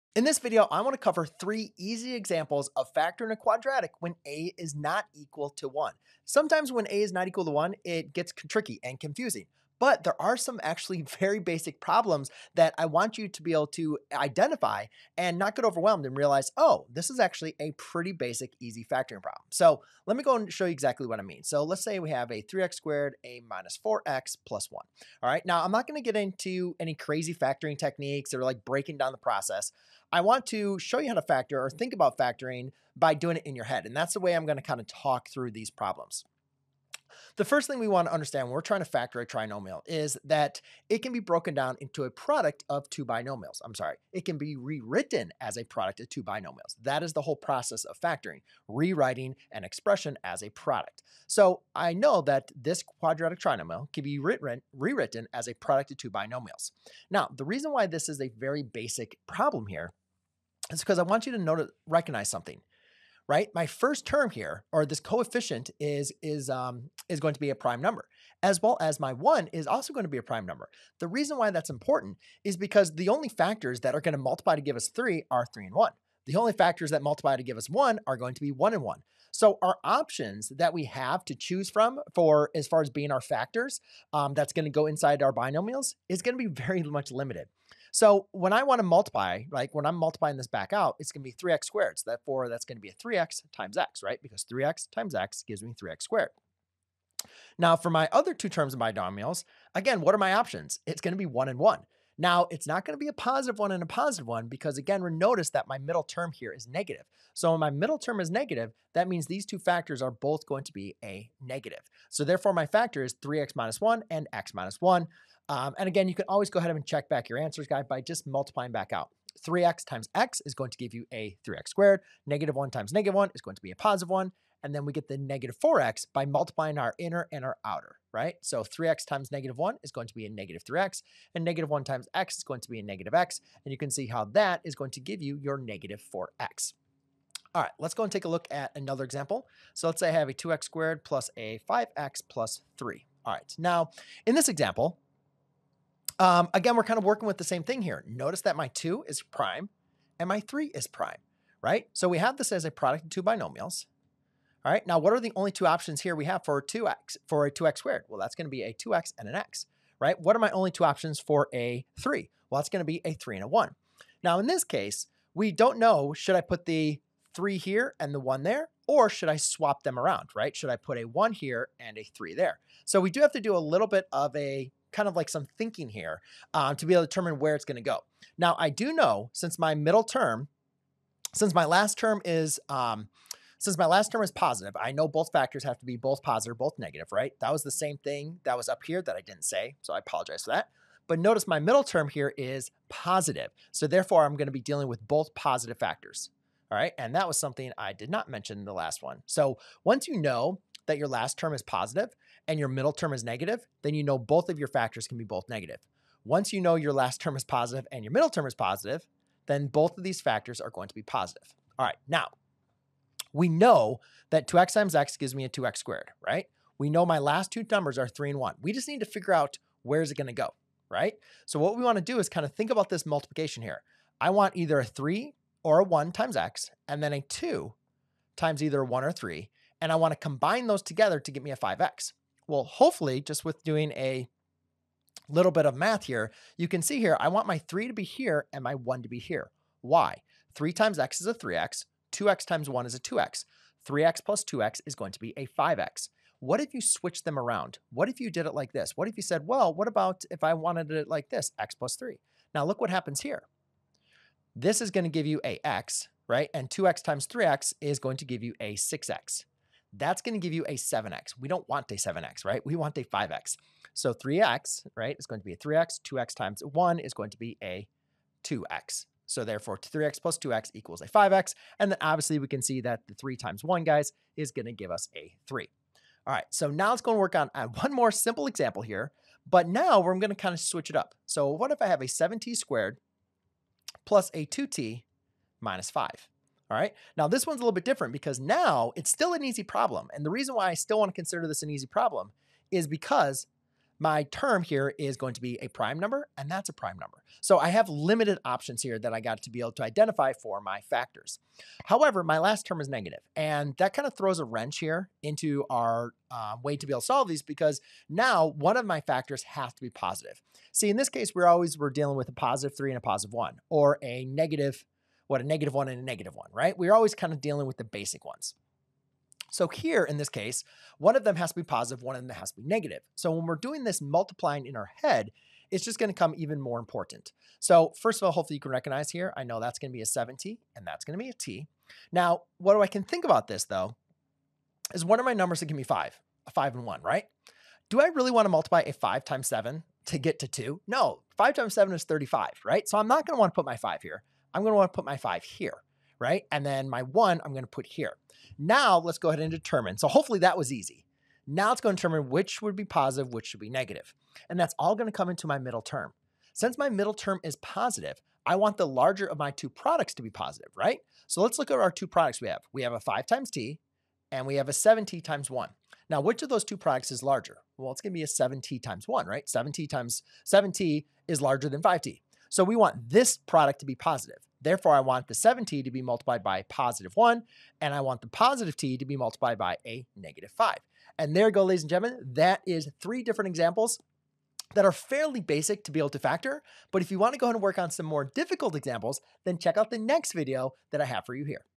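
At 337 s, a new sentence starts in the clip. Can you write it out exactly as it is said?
Do I really want to multiply a five times seven to get to two?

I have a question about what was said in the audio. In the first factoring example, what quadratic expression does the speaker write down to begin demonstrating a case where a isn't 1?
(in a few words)
3x squared minus 4x plus 1.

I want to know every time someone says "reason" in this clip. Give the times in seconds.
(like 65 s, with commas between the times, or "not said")
57 s, 71 s, 290 s.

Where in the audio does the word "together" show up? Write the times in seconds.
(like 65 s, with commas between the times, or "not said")
230 s.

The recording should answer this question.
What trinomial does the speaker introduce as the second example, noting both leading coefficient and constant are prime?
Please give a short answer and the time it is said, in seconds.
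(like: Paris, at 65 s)
2x squared plus 5x plus 3, at 140 s.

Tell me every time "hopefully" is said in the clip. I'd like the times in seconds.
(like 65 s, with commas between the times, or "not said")
232 s, 328 s, 350 s.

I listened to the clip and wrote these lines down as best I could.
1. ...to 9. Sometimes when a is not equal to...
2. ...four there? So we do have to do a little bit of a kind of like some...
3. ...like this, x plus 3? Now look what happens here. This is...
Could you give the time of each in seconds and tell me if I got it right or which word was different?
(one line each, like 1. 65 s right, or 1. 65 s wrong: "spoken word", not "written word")
1. 5 s wrong: "1", not "9"
2. 172 s wrong: "three", not "four"
3. 251 s right.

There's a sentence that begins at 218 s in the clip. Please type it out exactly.
We just need to figure out where's it going to go, right?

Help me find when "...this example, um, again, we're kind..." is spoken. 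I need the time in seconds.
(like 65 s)
144 s.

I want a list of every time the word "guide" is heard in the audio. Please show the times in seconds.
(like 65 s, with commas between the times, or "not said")
117 s.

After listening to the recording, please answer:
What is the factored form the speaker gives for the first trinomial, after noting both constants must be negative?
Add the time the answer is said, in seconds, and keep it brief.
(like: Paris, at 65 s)
3x minus 1 and x minus 1, at 113 s.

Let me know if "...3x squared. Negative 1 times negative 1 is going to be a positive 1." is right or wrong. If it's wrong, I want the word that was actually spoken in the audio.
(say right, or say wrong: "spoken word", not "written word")
right.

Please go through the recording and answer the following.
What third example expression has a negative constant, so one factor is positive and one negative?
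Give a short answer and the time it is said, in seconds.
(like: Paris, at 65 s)
7t squared plus 2t minus 5, at 282 s.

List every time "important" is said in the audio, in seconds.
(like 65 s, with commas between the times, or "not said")
71 s, 326 s.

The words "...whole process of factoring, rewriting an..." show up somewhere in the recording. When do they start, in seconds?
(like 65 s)
47 s.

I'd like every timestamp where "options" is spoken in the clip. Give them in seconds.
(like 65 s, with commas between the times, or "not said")
79 s, 100 s, 155 s, 160 s, 298 s.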